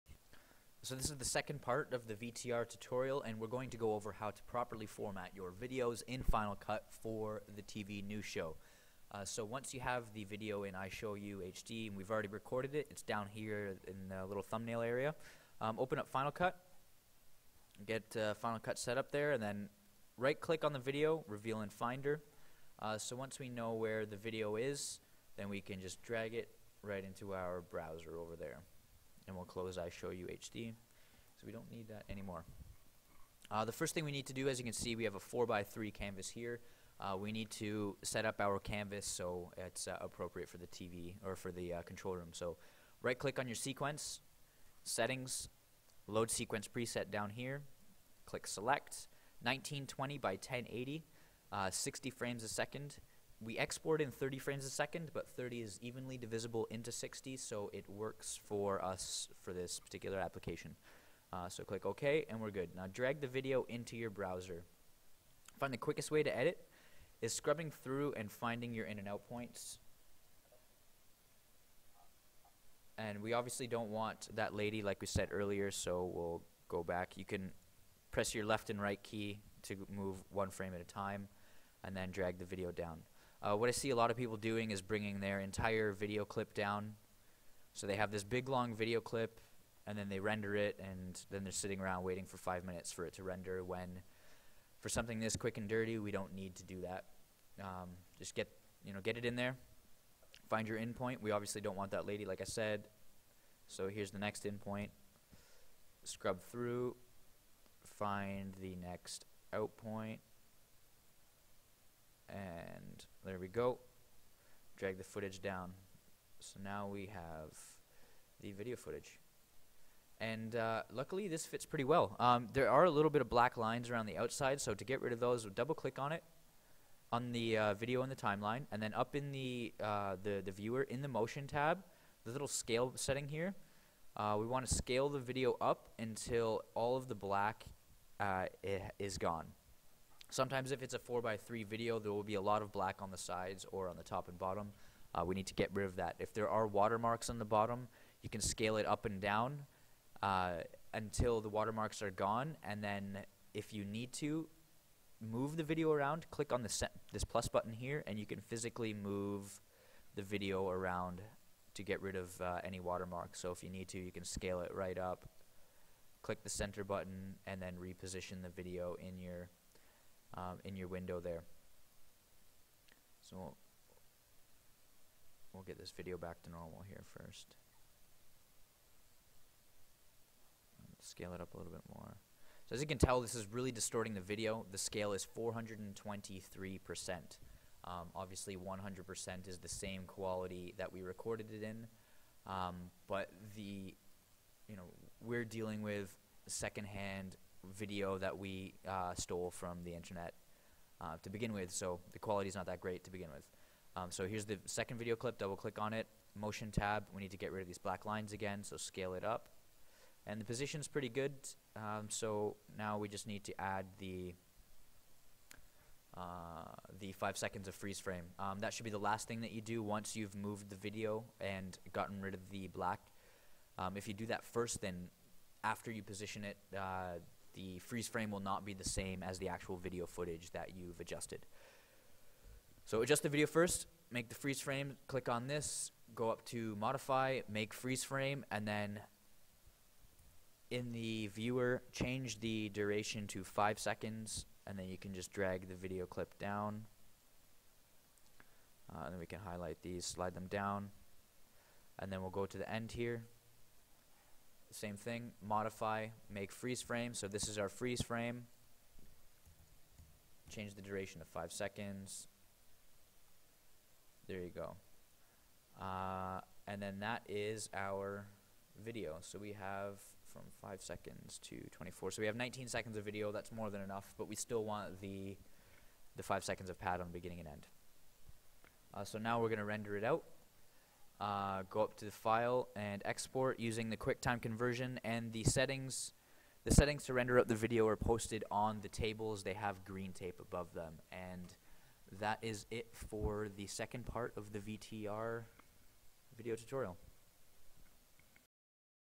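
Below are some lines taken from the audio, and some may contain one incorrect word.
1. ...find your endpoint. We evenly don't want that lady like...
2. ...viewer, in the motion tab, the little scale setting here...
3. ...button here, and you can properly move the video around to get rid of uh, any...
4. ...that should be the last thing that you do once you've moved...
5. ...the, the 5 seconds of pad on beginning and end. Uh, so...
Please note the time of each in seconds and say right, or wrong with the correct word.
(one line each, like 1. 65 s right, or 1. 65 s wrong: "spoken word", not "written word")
1. 100 s wrong: "obviously", not "evenly"
2. 130 s right
3. 157 s wrong: "physically", not "properly"
4. 218 s right
5. 275 s right.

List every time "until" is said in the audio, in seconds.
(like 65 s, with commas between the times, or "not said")
135 s, 150 s.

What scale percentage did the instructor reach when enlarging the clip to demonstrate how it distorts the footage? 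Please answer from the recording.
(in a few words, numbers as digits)
423%.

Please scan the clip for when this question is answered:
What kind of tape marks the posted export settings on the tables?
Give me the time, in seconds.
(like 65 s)
289 s.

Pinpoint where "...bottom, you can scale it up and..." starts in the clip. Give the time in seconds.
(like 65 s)
147 s.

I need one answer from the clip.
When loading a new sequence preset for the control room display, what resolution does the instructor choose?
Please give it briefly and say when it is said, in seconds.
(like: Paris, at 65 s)
1920 by 1080, at 49 s.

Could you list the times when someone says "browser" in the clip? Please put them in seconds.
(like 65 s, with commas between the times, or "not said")
27 s, 64 s.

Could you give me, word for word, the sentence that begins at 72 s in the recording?
And we obviously don't want that lady like we said earlier, so we'll go back.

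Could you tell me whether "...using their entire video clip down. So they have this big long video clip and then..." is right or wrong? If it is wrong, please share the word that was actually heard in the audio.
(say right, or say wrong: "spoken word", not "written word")
wrong: "bringing", not "using".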